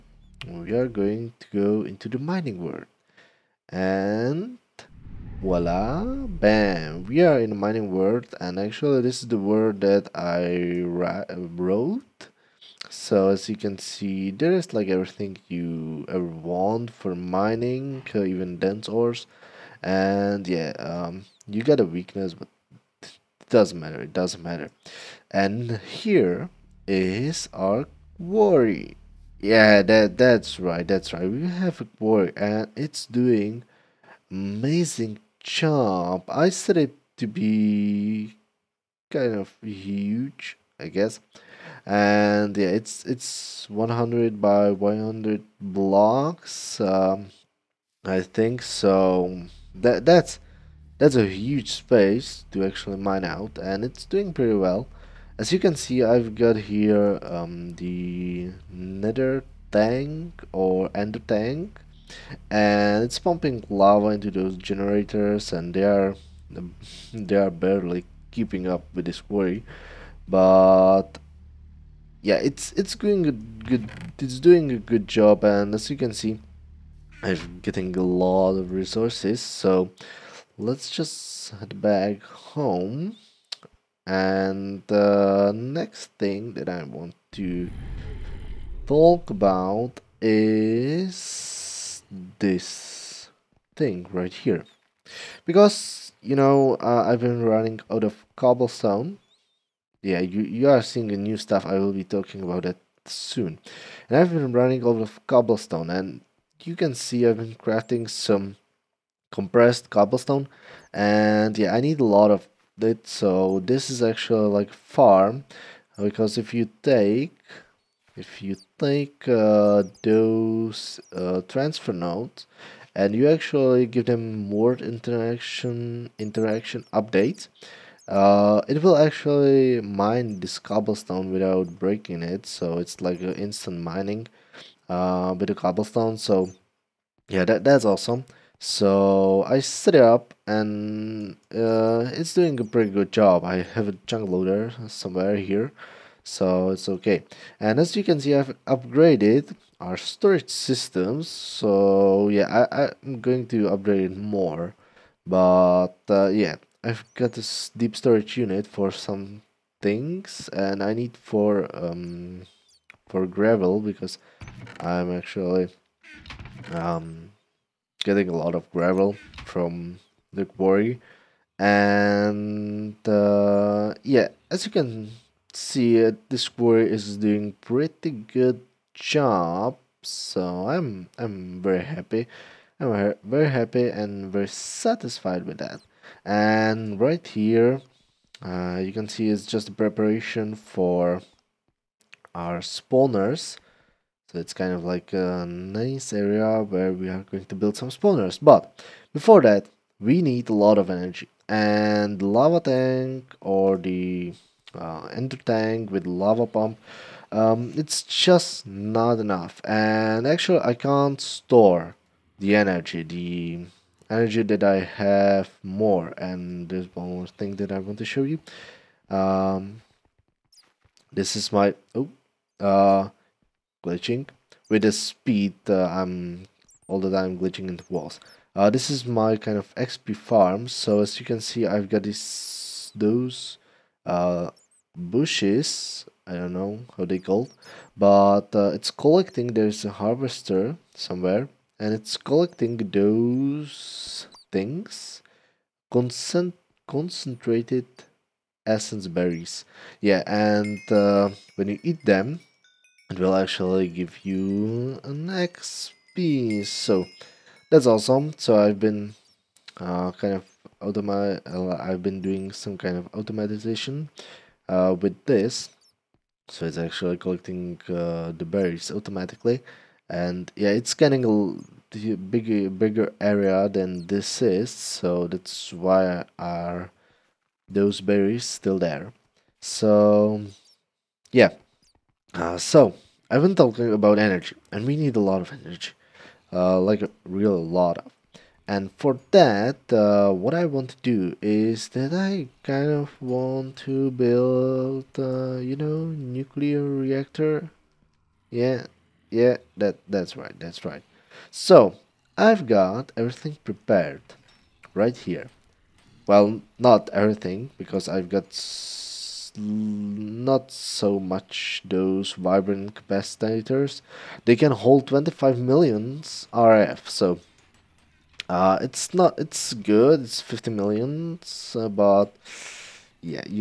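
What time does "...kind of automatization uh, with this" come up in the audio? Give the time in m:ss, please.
4:22.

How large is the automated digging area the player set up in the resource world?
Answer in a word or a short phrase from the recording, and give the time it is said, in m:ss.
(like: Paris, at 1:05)
100 by 100 blocks, at 0:43.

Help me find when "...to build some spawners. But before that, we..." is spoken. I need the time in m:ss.
3:17.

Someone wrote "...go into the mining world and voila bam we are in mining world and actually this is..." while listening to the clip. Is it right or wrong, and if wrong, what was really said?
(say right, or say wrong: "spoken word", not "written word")
right.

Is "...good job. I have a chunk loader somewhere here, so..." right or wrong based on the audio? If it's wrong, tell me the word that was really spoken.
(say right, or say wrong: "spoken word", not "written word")
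right.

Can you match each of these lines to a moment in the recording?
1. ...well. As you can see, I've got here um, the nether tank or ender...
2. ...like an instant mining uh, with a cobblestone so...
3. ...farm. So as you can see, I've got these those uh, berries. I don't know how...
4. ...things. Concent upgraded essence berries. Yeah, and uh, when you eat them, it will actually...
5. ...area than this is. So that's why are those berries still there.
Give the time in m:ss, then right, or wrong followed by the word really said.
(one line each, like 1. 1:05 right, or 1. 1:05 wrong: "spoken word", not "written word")
1. 0:54 right
2. 2:13 right
3. 3:50 wrong: "bushes", not "berries"
4. 4:04 wrong: "concentrated", not "upgraded"
5. 4:33 right.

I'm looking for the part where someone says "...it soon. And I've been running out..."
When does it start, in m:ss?
1:42.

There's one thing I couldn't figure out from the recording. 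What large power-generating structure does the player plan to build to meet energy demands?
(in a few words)
nuclear reactor.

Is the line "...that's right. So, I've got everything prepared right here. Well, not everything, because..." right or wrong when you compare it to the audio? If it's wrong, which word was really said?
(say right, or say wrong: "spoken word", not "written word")
right.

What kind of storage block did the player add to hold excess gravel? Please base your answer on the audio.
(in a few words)
deep storage unit.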